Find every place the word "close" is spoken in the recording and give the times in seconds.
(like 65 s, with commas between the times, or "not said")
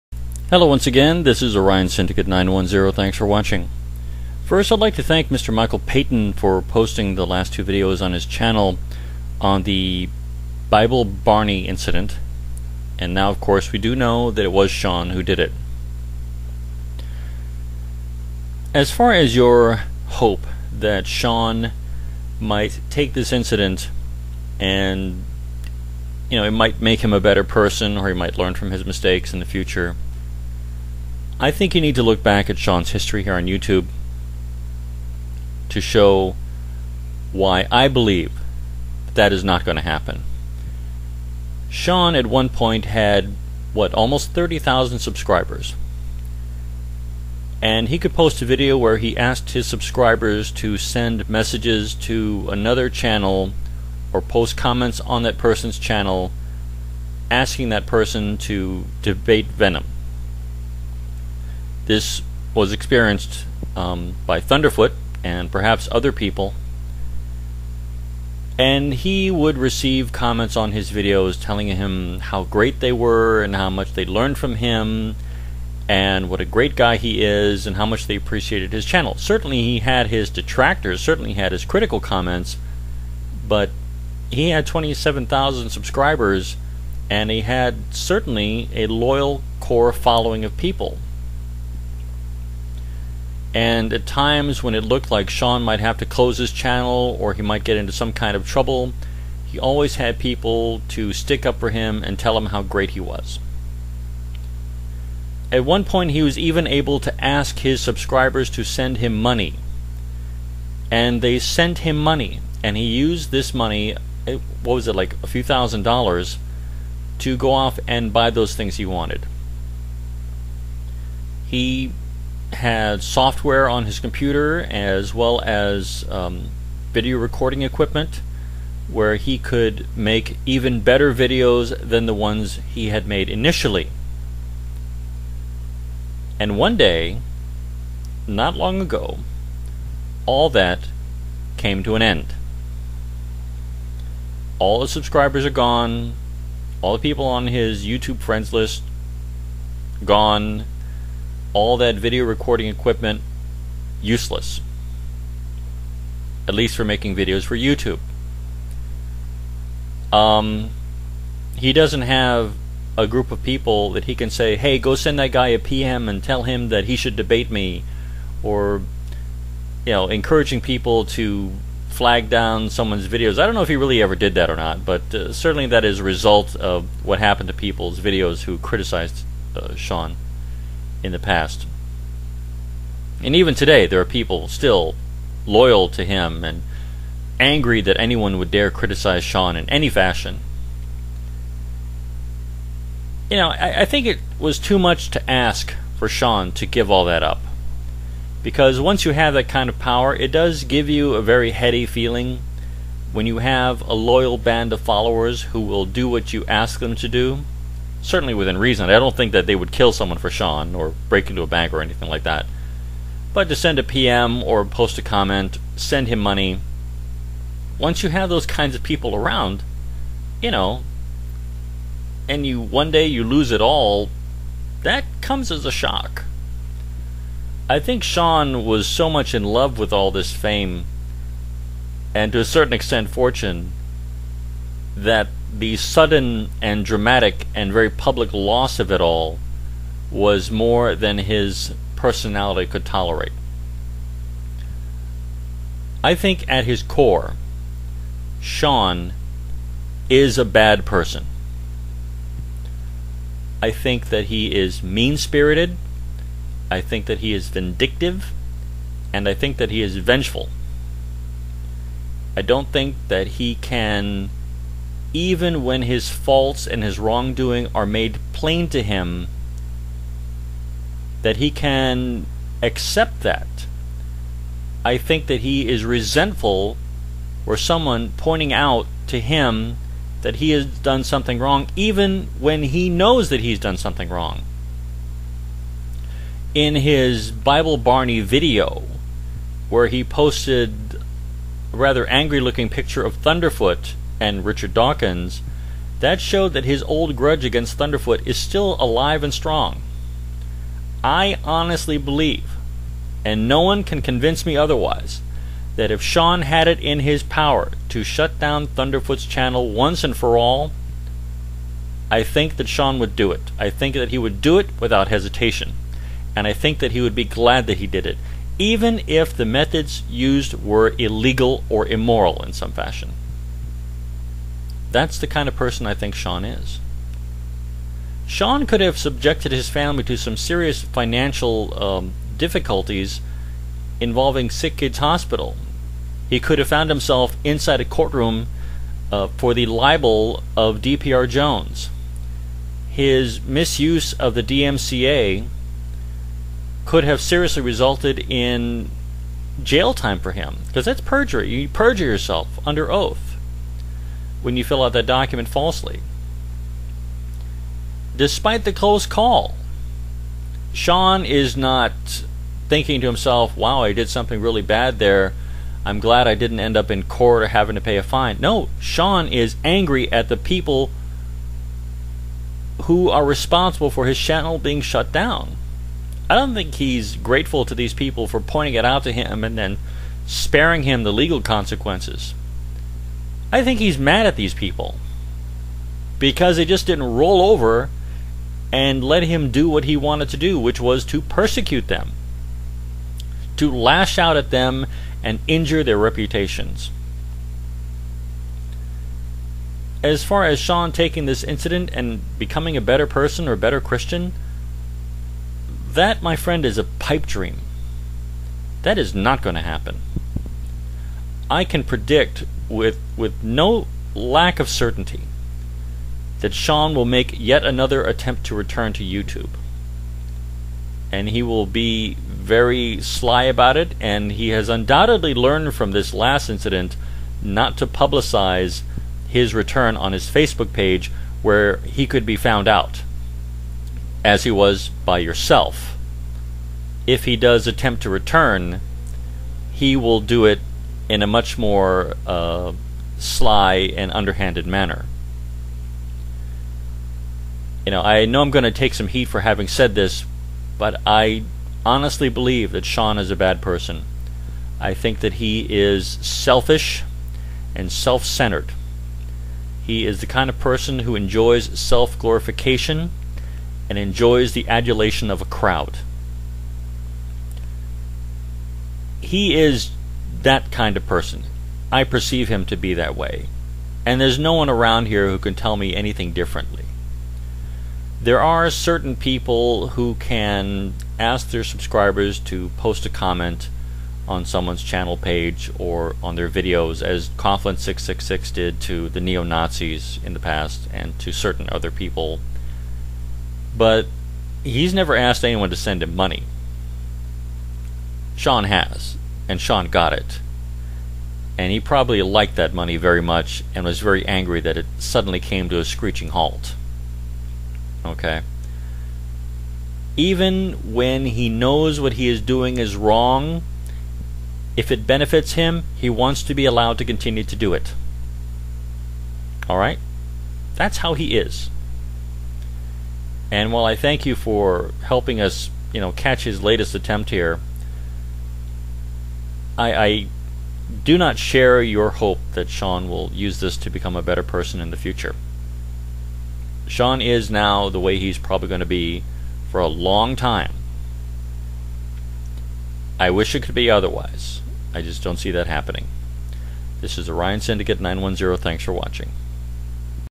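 96 s, 358 s.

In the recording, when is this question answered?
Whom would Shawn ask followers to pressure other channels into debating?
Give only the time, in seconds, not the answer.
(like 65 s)
59 s.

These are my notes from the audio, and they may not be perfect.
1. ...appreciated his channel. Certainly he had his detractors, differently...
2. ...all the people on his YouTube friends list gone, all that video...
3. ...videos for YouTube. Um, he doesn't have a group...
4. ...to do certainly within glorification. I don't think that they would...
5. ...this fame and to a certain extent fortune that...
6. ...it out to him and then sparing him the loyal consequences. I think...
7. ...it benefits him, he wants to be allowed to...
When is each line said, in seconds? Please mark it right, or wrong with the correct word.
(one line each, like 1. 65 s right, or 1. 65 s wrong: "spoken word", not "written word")
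1. 78 s wrong: "certainly", not "differently"
2. 146 s right
3. 157 s right
4. 206 s wrong: "reason", not "glorification"
5. 230 s right
6. 378 s wrong: "legal", not "loyal"
7. 514 s right.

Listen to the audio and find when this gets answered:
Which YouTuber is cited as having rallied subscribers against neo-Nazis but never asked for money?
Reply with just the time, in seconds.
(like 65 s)
487 s.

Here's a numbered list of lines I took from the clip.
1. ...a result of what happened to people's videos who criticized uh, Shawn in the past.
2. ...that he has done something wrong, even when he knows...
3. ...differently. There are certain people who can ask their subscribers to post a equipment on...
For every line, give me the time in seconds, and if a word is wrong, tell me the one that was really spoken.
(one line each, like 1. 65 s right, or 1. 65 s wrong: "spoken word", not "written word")
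1. 175 s right
2. 280 s right
3. 476 s wrong: "comment", not "equipment".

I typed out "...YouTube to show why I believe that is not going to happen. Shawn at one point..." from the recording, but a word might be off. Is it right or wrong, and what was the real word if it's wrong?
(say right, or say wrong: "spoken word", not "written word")
right.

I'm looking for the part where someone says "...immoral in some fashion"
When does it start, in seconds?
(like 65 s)
321 s.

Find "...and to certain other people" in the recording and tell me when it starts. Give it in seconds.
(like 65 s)
490 s.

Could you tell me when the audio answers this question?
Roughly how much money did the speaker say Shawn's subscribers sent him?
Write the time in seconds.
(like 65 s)
115 s.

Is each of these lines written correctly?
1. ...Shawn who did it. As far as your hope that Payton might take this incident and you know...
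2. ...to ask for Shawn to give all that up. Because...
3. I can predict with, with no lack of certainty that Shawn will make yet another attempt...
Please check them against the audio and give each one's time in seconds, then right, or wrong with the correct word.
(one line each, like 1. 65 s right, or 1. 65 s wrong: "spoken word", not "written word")
1. 14 s wrong: "Shawn", not "Payton"
2. 195 s right
3. 411 s right.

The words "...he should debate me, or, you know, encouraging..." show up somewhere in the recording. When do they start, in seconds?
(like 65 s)
166 s.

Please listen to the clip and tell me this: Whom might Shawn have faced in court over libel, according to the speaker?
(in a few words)
DPR Jones.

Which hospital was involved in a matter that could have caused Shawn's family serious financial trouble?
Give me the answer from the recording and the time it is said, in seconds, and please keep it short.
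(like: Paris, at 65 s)
Sick Kids Hospital, at 334 s.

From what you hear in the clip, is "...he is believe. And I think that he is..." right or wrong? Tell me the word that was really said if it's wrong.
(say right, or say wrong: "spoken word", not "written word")
wrong: "vindictive", not "believe".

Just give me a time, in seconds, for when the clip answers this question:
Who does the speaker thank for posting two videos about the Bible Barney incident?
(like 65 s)
5 s.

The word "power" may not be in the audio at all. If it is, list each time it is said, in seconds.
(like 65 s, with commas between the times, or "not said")
199 s, 307 s.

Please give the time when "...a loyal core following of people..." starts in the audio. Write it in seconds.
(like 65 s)
88 s.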